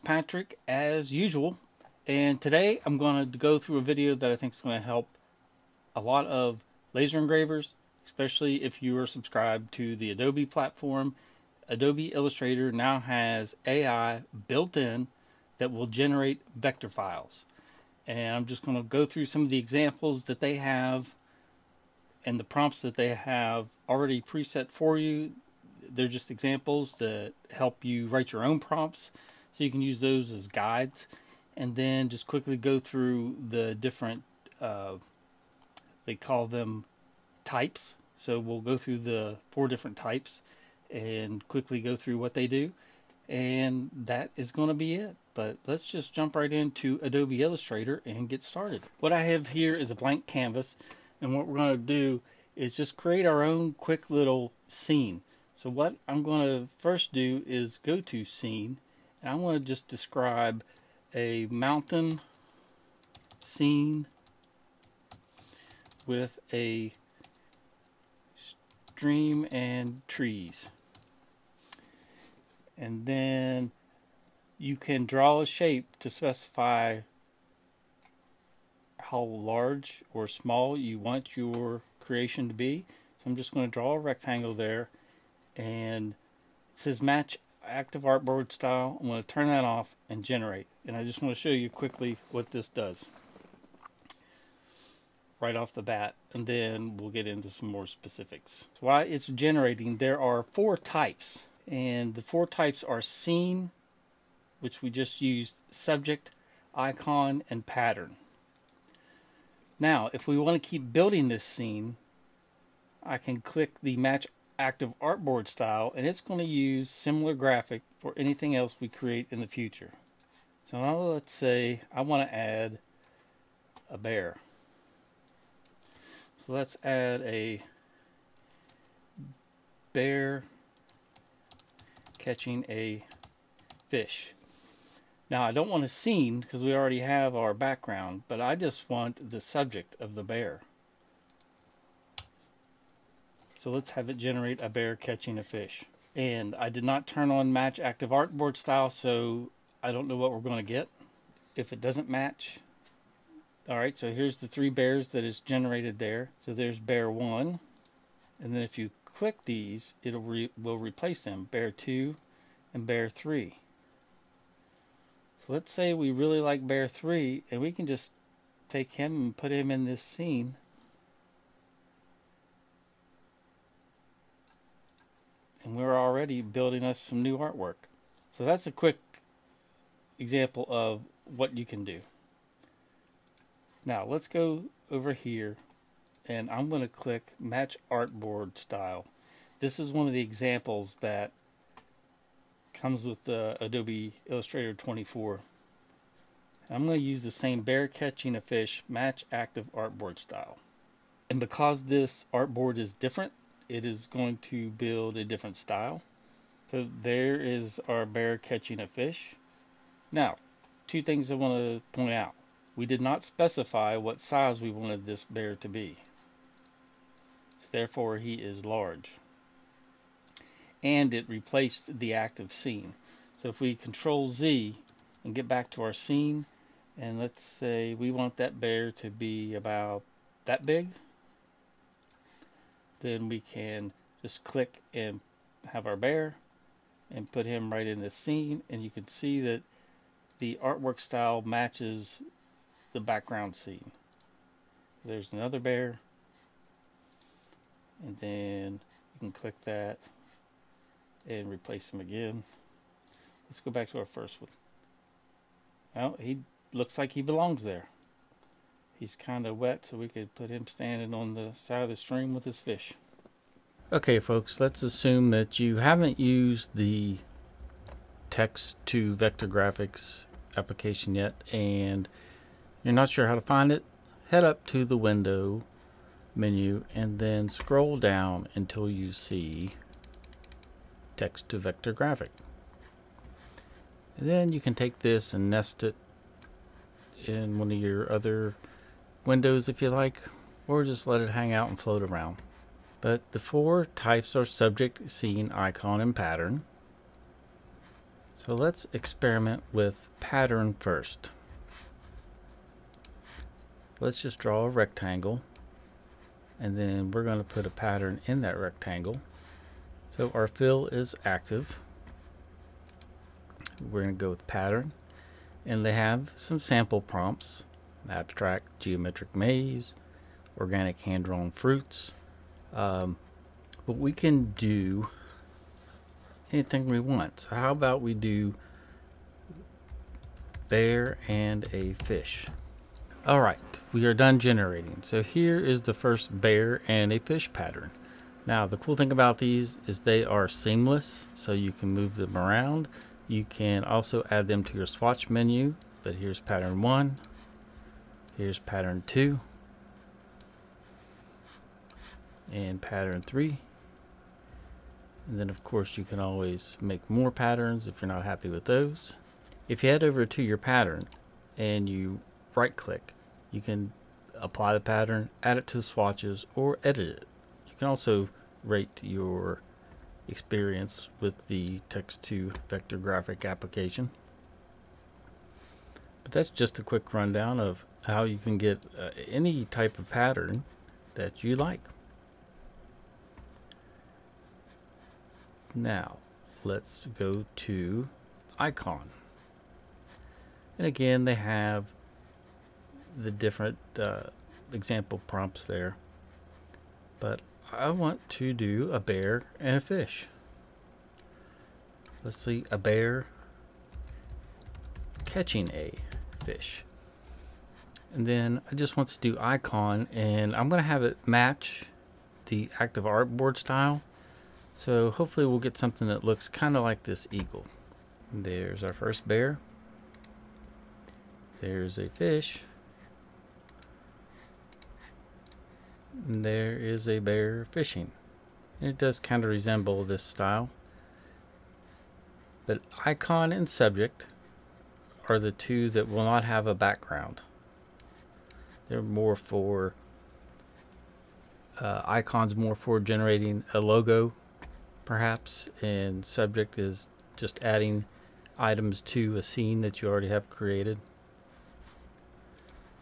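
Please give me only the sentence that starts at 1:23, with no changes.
So I'm just going to draw a rectangle there and it says match active artboard style.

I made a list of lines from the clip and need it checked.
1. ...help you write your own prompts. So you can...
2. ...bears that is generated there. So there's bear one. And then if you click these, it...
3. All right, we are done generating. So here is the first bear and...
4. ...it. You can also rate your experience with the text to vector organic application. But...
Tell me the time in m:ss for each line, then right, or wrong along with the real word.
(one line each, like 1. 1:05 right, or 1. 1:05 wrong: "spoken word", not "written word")
1. 0:27 right
2. 2:34 right
3. 5:33 right
4. 6:07 wrong: "graphic", not "organic".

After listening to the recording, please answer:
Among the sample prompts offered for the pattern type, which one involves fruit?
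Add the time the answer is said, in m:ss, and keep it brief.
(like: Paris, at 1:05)
Organic hand-drawn fruits, at 5:20.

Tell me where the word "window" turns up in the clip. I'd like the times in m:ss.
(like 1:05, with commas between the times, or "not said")
4:34, 4:49.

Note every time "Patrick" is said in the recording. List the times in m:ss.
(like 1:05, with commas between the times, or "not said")
0:00.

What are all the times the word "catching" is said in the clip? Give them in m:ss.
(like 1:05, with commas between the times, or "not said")
2:12, 2:24, 3:17, 3:28, 6:45.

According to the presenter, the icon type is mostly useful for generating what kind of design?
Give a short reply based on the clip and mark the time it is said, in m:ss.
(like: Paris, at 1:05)
A logo, at 7:23.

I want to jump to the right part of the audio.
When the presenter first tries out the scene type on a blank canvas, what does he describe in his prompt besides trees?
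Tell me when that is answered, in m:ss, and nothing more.
1:01.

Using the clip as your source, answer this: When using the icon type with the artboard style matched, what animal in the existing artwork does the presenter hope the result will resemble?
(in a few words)
Eagle.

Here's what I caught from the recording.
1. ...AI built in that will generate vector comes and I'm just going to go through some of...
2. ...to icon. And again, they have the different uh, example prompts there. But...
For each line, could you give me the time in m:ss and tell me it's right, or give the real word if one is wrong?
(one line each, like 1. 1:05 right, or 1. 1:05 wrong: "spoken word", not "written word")
1. 0:13 wrong: "files", not "comes"
2. 6:27 right.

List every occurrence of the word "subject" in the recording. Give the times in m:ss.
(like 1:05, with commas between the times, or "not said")
1:45, 2:19, 4:54, 7:13, 7:26.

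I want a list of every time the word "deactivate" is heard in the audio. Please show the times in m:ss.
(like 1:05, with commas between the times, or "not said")
not said.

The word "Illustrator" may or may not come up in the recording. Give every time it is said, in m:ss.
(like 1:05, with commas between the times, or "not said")
0:12, 0:47, 3:14.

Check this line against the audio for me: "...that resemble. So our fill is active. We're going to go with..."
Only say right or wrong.
wrong.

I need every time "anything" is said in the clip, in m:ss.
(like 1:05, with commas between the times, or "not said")
1:58, 5:26.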